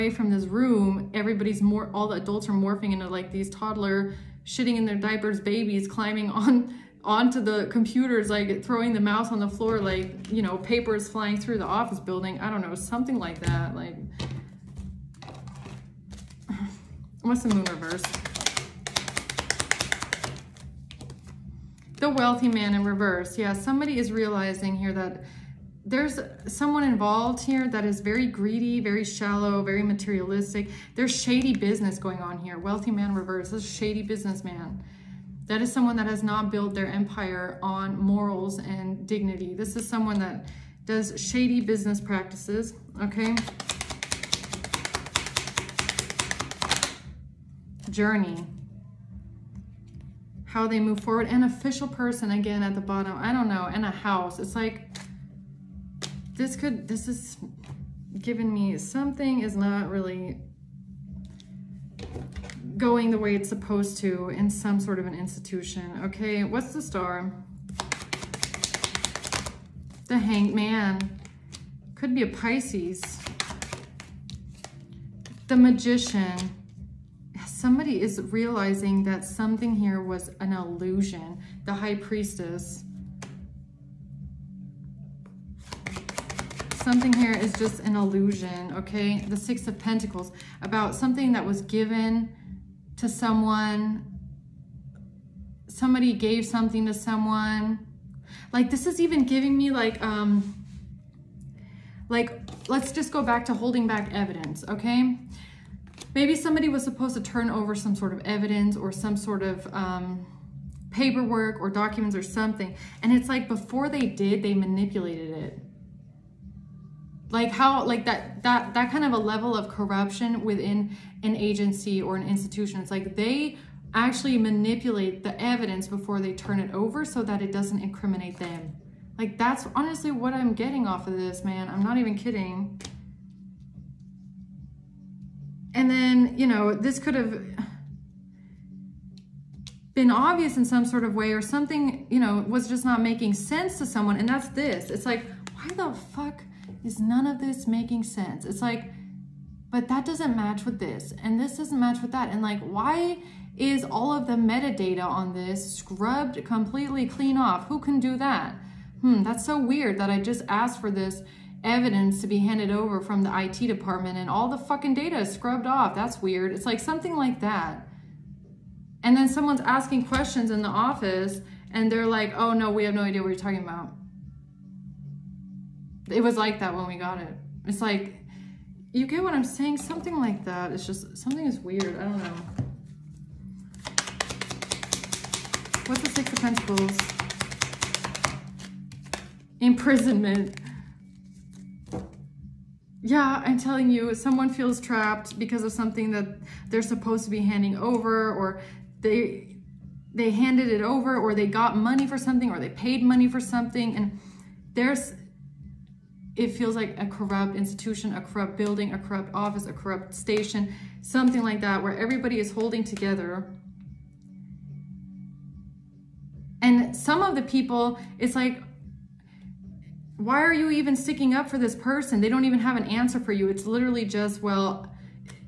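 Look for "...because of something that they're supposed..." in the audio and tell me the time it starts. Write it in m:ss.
3:15.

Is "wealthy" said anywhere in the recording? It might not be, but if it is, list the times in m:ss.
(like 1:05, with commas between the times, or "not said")
0:22, 0:32.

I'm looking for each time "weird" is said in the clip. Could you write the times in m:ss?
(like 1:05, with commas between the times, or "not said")
2:39, 2:46, 3:01.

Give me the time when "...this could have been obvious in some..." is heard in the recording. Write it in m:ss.
2:16.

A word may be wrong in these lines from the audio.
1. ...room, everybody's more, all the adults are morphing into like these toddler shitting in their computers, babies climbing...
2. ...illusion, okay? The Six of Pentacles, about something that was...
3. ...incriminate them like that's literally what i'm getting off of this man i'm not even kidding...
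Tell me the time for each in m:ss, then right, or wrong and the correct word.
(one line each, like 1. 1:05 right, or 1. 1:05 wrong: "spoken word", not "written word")
1. 0:00 wrong: "diapers", not "computers"
2. 1:27 right
3. 2:07 wrong: "honestly", not "literally".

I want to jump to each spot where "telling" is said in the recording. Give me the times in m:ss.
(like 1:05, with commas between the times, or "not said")
3:13.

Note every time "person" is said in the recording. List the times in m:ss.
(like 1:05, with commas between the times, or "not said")
0:51, 3:41.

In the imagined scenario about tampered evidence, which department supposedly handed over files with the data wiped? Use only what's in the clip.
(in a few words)
IT department.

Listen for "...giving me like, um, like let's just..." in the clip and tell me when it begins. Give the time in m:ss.
1:39.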